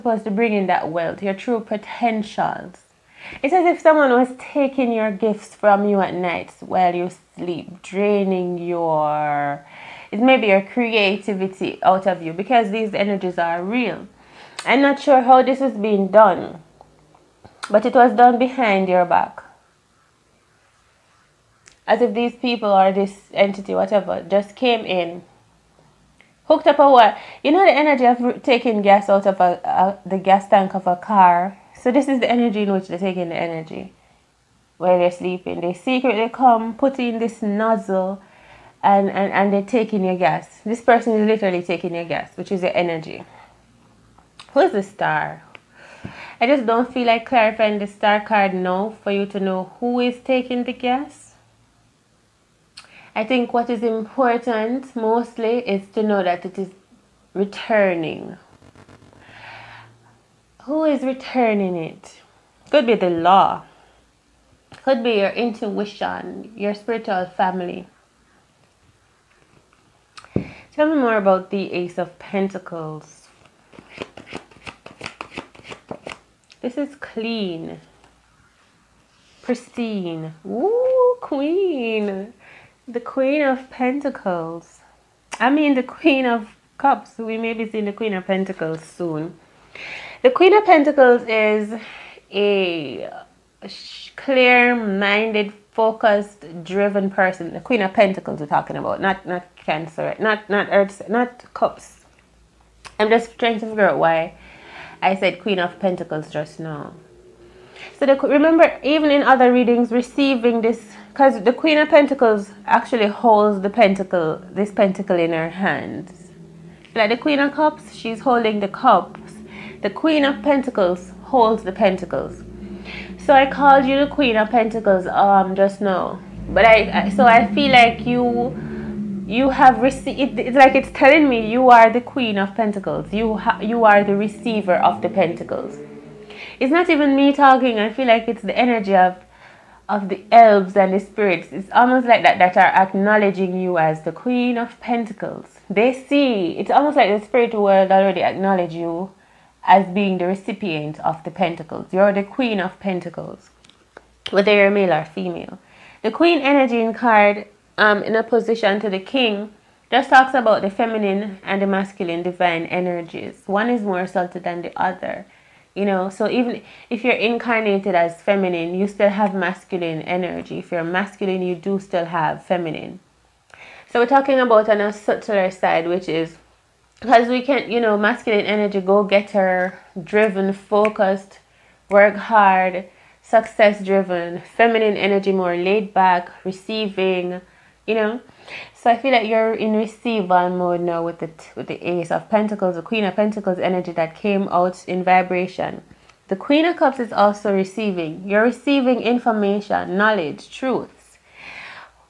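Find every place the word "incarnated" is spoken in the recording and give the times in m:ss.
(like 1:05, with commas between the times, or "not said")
2:47.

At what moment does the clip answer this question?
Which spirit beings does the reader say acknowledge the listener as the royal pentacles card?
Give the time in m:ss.
2:20.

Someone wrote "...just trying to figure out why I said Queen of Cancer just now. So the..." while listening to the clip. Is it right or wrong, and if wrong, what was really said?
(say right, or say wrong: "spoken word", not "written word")
wrong: "Pentacles", not "Cancer".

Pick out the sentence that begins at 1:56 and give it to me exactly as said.
Like the Queen of Cups, she's holding the cups.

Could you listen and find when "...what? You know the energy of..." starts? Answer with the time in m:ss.
0:26.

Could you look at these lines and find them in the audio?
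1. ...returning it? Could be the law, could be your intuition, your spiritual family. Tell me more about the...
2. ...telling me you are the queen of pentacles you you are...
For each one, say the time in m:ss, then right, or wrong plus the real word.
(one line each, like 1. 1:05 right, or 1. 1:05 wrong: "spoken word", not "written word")
1. 1:01 right
2. 2:10 right.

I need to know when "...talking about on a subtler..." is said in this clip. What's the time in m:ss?
2:54.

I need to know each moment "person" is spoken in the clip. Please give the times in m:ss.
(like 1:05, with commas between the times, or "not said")
0:40, 1:37.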